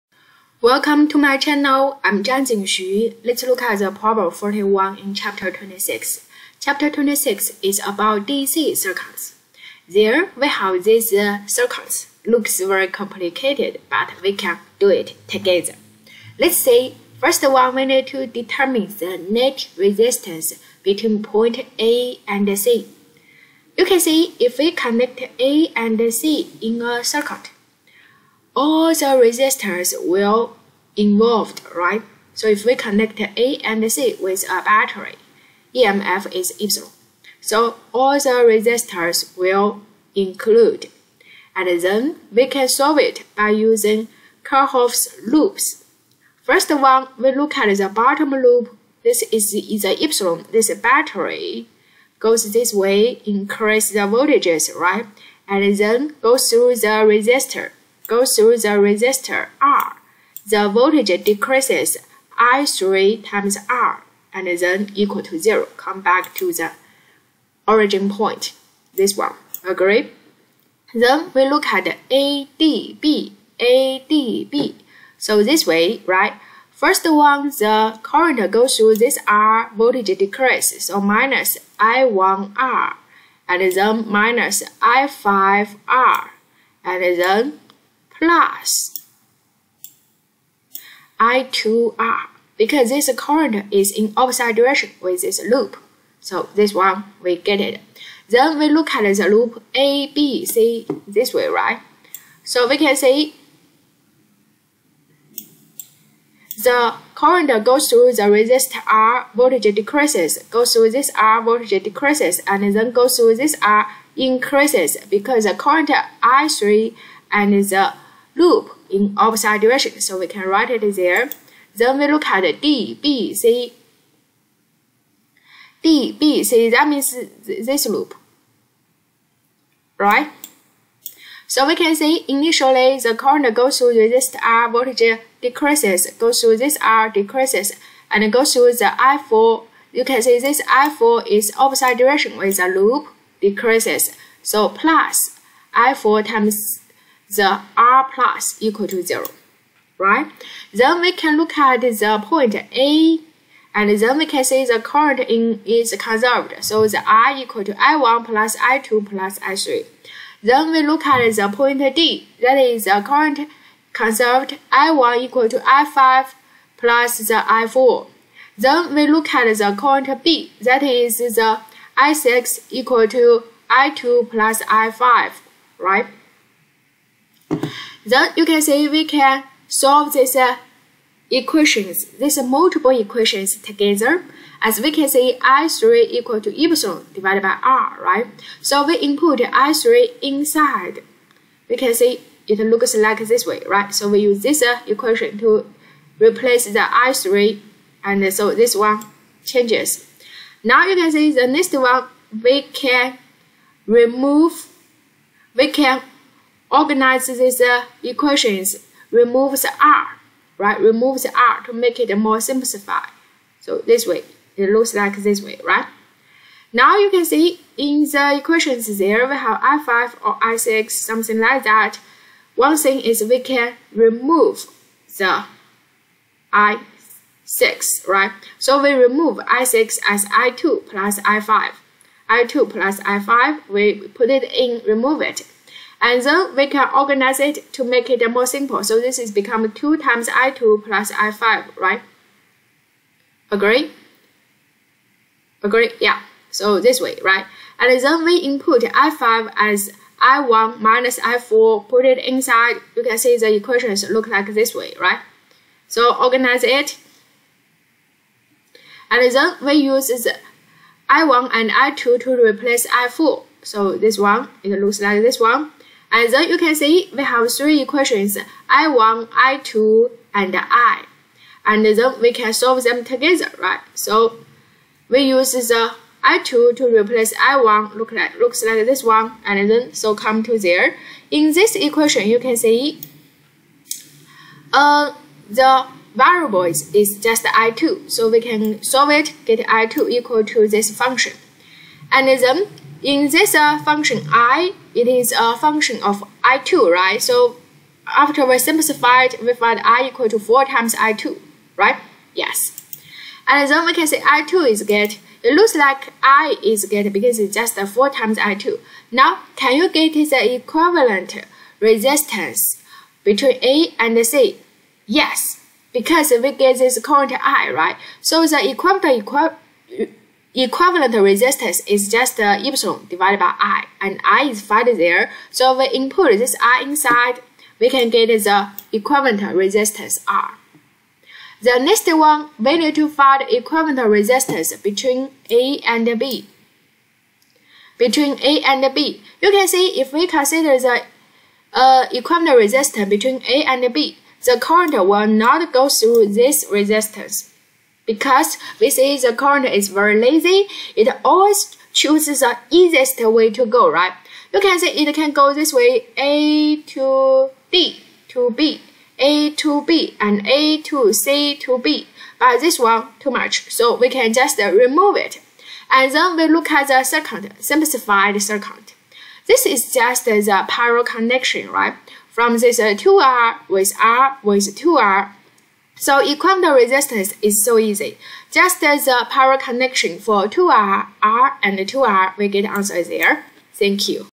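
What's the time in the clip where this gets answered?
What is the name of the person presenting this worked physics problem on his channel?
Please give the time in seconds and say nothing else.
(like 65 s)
2 s.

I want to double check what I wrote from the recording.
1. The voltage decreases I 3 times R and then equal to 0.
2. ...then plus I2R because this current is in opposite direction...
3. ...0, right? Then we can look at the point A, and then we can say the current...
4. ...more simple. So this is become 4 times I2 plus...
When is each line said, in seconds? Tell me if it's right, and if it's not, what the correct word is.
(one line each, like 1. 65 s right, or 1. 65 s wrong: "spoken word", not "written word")
1. 60 s right
2. 87 s right
3. 149 s right
4. 238 s wrong: "2", not "4".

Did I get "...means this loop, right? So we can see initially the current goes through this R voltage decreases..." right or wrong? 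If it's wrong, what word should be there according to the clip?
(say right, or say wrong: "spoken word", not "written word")
right.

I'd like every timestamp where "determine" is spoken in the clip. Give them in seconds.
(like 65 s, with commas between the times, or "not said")
18 s.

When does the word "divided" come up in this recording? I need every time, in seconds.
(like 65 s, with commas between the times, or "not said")
187 s, 323 s.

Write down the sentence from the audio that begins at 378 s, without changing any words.
Just as the power connection for 2R, R and 2R, we get answer there.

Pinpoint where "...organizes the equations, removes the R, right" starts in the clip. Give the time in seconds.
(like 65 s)
206 s.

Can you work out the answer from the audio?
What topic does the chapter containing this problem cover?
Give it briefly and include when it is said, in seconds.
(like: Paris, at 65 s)
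DC circuits, at 8 s.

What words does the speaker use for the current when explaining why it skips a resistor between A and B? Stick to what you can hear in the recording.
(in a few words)
very lazy.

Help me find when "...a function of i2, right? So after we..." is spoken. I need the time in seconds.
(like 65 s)
295 s.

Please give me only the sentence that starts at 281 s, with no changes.
In this equation, you can see uh, the variables is just I2.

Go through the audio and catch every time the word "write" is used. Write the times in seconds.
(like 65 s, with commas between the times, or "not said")
120 s.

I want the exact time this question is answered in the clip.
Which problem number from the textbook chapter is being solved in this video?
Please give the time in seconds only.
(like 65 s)
3 s.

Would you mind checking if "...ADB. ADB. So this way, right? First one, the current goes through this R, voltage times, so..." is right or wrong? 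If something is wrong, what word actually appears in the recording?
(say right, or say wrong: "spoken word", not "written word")
wrong: "decreases", not "times".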